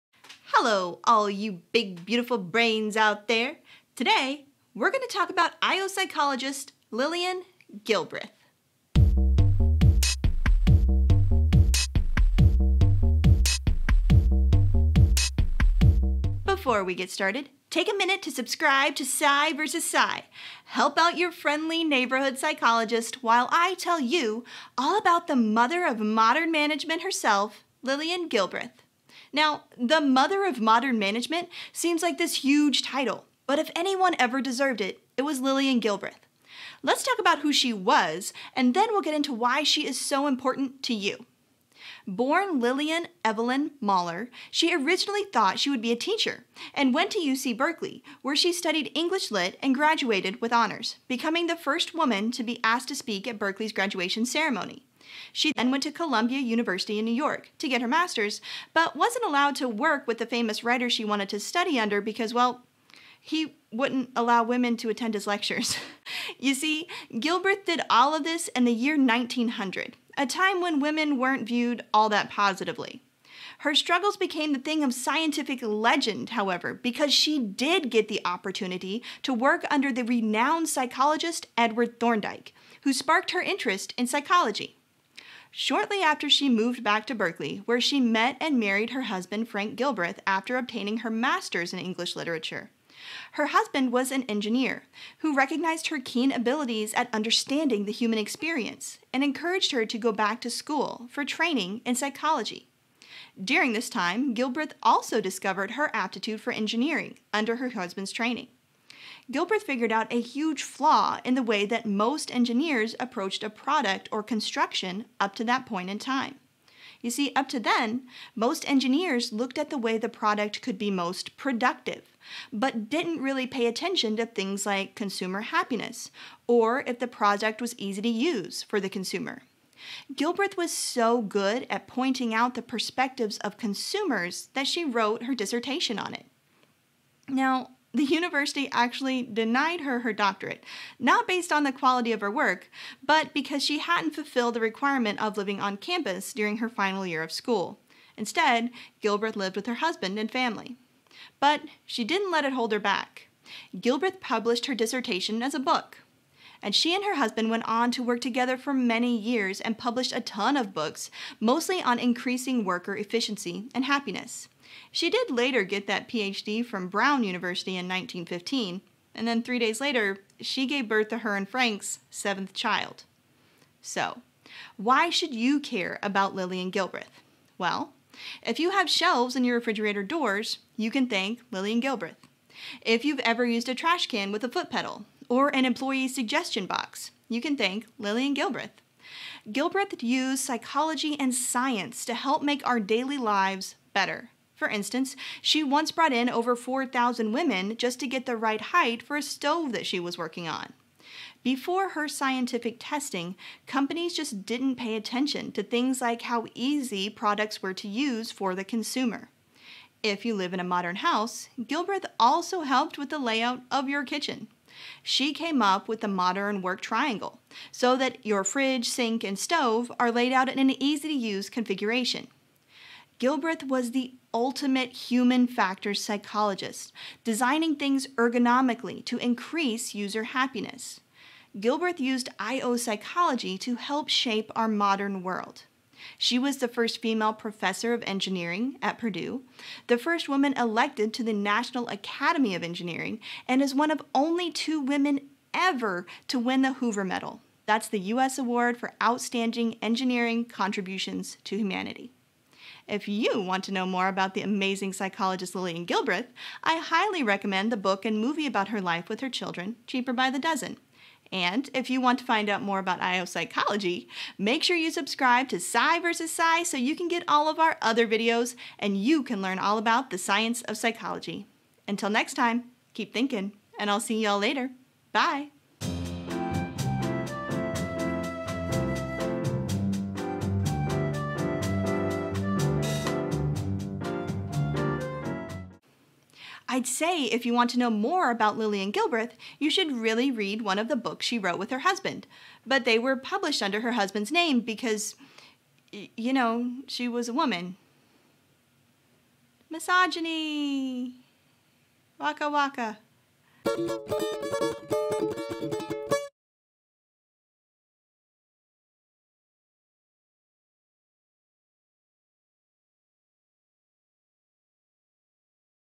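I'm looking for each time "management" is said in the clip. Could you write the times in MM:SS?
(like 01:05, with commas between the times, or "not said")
00:26, 00:30.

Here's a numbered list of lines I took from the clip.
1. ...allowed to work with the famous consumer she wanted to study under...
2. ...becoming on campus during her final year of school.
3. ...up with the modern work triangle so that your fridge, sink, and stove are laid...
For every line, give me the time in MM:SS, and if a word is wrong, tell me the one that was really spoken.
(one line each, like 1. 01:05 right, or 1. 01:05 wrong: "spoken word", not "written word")
1. 00:59 wrong: "writer", not "consumer"
2. 02:25 wrong: "living", not "becoming"
3. 03:35 right.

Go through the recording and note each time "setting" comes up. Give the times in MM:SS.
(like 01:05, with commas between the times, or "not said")
not said.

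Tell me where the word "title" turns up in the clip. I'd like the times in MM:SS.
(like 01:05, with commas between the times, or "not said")
00:32.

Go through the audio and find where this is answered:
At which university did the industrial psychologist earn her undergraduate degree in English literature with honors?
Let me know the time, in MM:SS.
00:47.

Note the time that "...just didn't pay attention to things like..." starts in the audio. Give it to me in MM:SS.
03:24.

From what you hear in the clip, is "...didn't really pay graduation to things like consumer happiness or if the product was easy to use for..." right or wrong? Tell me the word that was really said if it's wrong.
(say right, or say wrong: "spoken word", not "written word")
wrong: "attention", not "graduation".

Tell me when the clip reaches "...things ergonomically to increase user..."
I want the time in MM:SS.
03:47.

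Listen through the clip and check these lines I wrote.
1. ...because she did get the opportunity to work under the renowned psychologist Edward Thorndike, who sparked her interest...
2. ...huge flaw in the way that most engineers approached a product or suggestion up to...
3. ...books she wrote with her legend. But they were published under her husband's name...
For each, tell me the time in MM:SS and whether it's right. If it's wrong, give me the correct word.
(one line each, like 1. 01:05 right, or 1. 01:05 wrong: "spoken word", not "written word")
1. 01:16 right
2. 01:50 wrong: "construction", not "suggestion"
3. 04:50 wrong: "husband", not "legend".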